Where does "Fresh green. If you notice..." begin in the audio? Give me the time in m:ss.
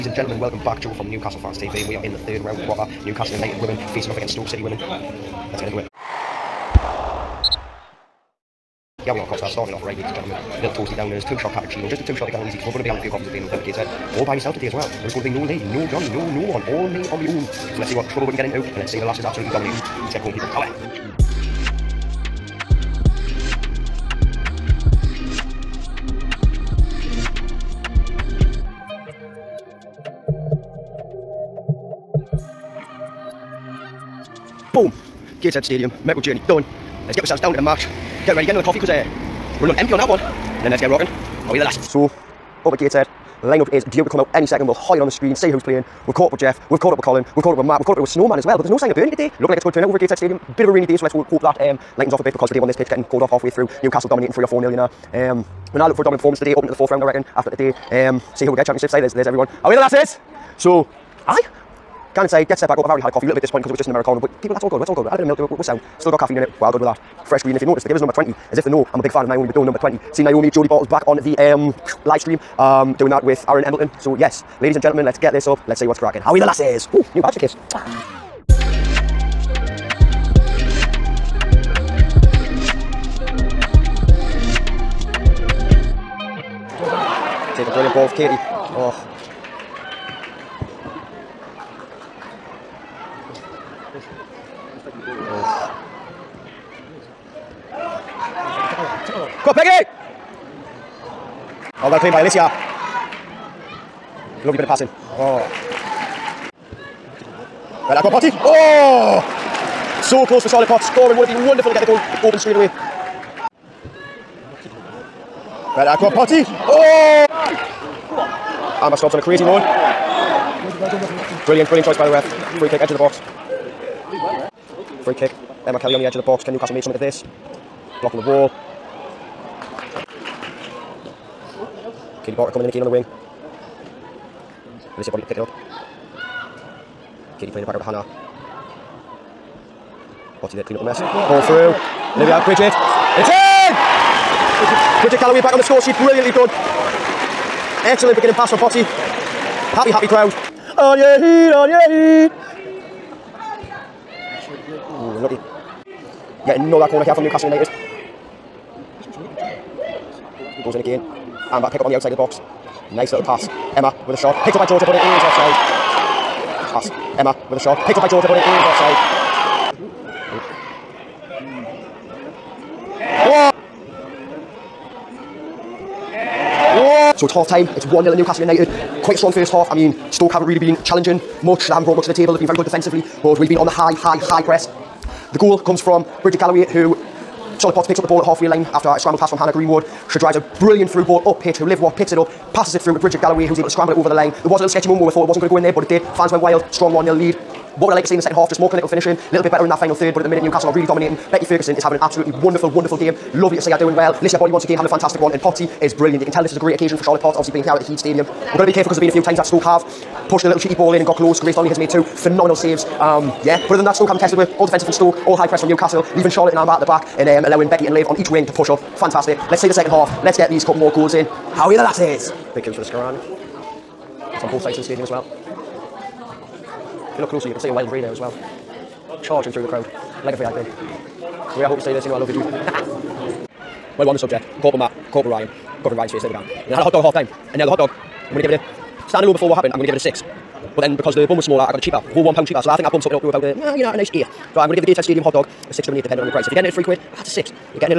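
1:07.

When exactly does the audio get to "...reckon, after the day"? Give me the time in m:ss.
0:57.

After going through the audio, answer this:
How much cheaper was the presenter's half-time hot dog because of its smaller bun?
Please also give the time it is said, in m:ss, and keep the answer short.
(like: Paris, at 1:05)
£1, at 4:01.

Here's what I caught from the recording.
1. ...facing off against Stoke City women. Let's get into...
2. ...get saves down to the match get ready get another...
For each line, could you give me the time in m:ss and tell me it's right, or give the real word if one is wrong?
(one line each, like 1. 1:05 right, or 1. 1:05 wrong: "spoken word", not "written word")
1. 0:03 right
2. 0:37 wrong: "ourselves", not "saves".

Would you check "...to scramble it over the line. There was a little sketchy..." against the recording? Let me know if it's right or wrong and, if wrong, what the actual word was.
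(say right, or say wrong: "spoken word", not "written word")
right.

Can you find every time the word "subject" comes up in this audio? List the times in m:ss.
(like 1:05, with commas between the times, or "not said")
3:54.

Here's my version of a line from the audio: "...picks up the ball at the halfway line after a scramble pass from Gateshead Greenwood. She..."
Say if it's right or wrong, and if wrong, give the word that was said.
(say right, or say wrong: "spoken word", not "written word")
wrong: "Hannah", not "Gateshead".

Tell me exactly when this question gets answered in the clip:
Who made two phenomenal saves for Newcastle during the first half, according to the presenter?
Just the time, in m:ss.
3:31.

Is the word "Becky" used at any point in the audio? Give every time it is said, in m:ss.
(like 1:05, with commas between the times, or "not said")
3:21, 3:37.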